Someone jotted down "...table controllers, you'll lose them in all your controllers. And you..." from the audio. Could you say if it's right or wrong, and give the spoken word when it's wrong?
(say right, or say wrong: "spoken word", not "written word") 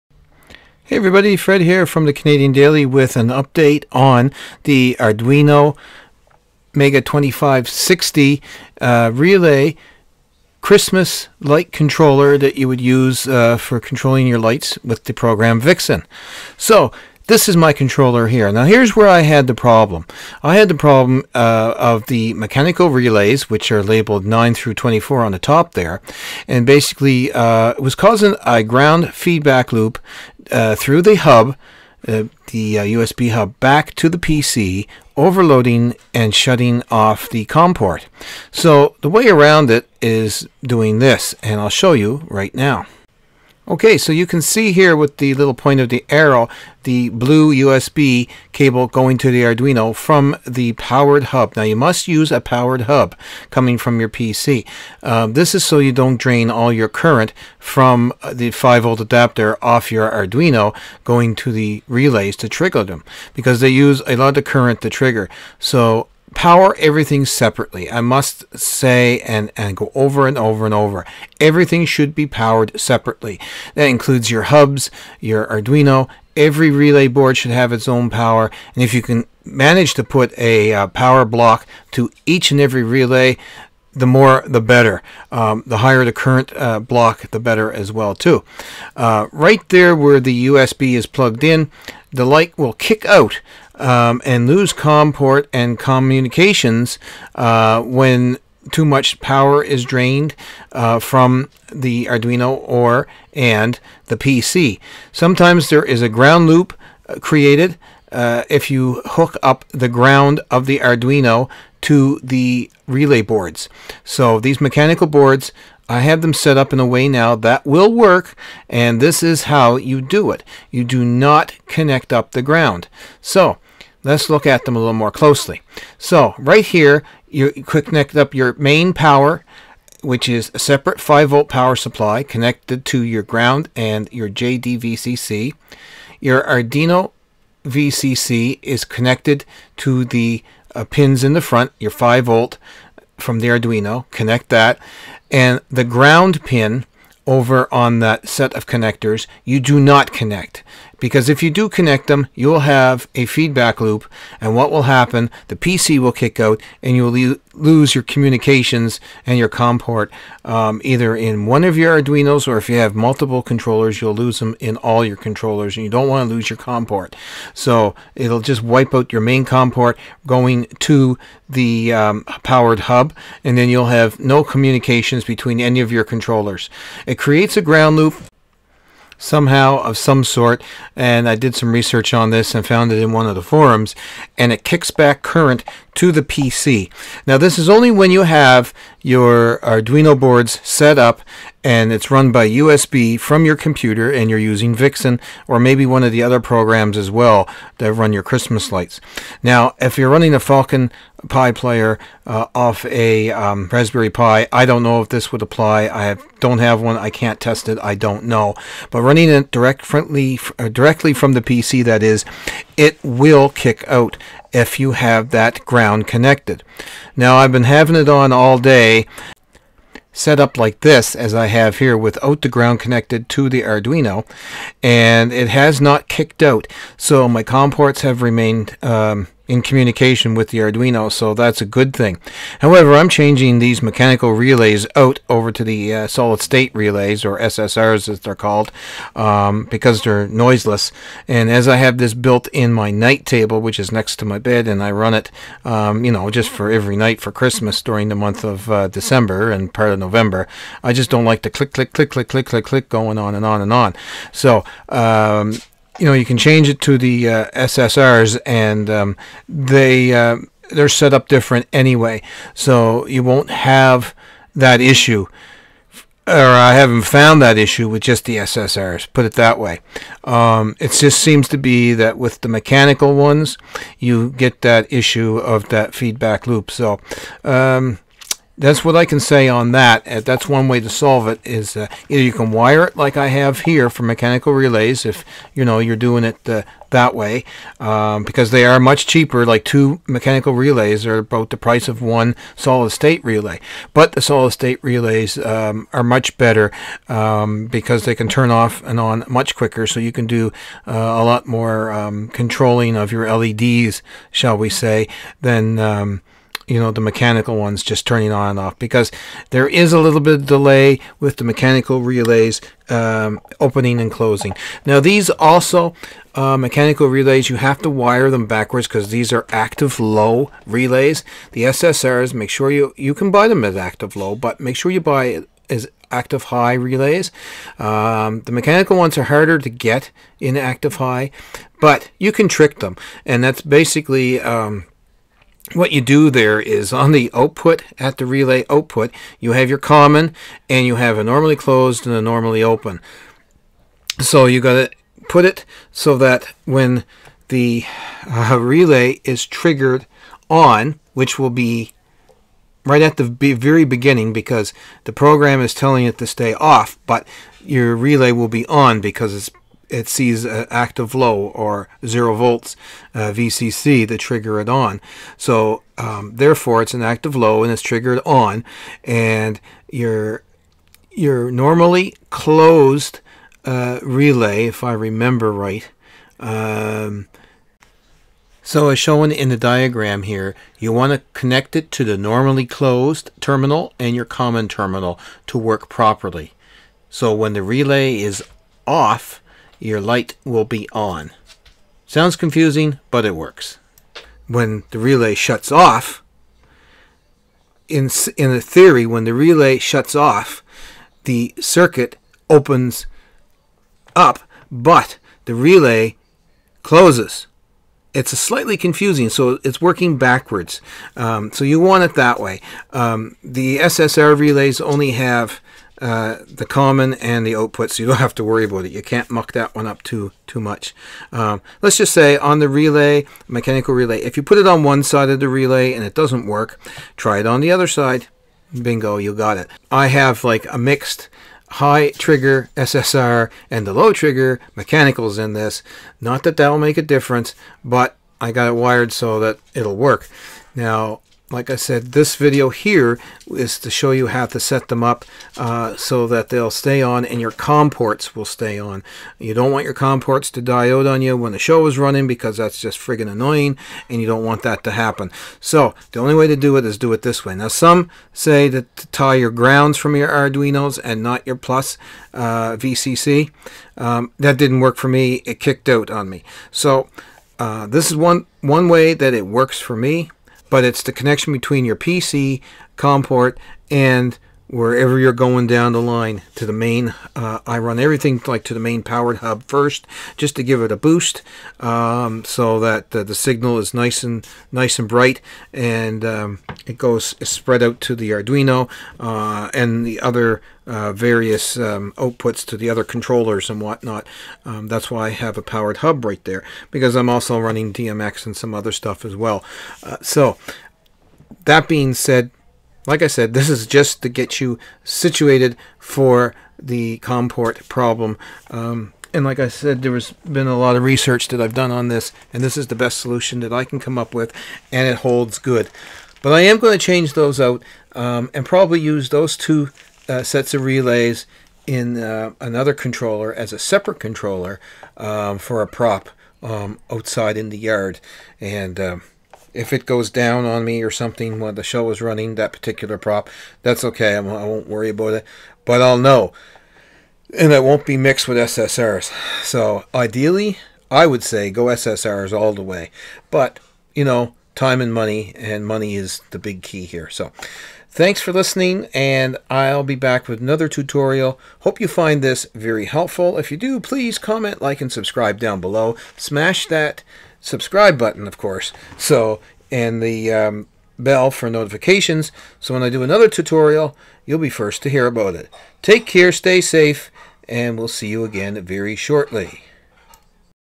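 wrong: "multiple", not "table".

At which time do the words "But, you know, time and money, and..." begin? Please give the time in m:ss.
9:03.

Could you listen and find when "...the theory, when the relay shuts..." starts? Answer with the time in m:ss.
6:38.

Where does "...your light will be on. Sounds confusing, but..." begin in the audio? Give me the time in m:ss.
6:29.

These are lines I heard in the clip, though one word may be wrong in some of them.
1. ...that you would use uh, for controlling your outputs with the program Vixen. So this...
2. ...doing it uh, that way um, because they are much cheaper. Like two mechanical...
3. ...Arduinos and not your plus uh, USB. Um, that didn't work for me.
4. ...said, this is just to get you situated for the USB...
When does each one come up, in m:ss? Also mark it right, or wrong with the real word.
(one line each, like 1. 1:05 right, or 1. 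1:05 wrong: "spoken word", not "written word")
1. 0:12 wrong: "lights", not "outputs"
2. 4:45 right
3. 7:40 wrong: "VCC", not "USB"
4. 8:23 wrong: "COM", not "USB".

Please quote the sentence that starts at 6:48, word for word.
It's slightly confusing, so it's working backwards.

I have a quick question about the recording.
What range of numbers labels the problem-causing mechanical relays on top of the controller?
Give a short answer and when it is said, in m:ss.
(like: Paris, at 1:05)
9 through 24, at 0:24.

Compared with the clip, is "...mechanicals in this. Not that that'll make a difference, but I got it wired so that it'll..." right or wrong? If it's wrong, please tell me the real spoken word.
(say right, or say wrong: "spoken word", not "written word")
right.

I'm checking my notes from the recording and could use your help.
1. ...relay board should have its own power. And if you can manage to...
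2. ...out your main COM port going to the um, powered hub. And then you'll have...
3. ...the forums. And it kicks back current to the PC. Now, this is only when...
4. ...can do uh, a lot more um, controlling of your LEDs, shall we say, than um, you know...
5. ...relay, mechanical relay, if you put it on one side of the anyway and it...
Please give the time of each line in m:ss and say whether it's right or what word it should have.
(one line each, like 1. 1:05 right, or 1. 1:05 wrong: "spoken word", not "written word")
1. 1:16 right
2. 2:48 right
3. 3:03 right
4. 5:00 right
5. 7:02 wrong: "relay", not "anyway".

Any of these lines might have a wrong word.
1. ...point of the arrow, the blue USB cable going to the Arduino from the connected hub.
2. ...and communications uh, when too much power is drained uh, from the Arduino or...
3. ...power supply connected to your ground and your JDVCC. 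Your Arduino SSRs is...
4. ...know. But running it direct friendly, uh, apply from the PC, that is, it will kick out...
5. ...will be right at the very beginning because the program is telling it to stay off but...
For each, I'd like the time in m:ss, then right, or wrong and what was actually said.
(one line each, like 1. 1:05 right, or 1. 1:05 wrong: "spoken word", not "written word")
1. 0:45 wrong: "powered", not "connected"
2. 1:35 right
3. 2:11 wrong: "VCC", not "SSRs"
4. 3:28 wrong: "directly", not "apply"
5. 5:51 right.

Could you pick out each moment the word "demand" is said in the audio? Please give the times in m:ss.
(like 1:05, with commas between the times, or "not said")
not said.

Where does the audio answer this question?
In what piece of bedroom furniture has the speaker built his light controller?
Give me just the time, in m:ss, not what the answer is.
4:02.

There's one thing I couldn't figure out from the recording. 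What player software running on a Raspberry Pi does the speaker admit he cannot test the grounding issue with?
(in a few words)
Falcon Pi player.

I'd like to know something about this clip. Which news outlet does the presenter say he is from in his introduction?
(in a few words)
Canadian Daily.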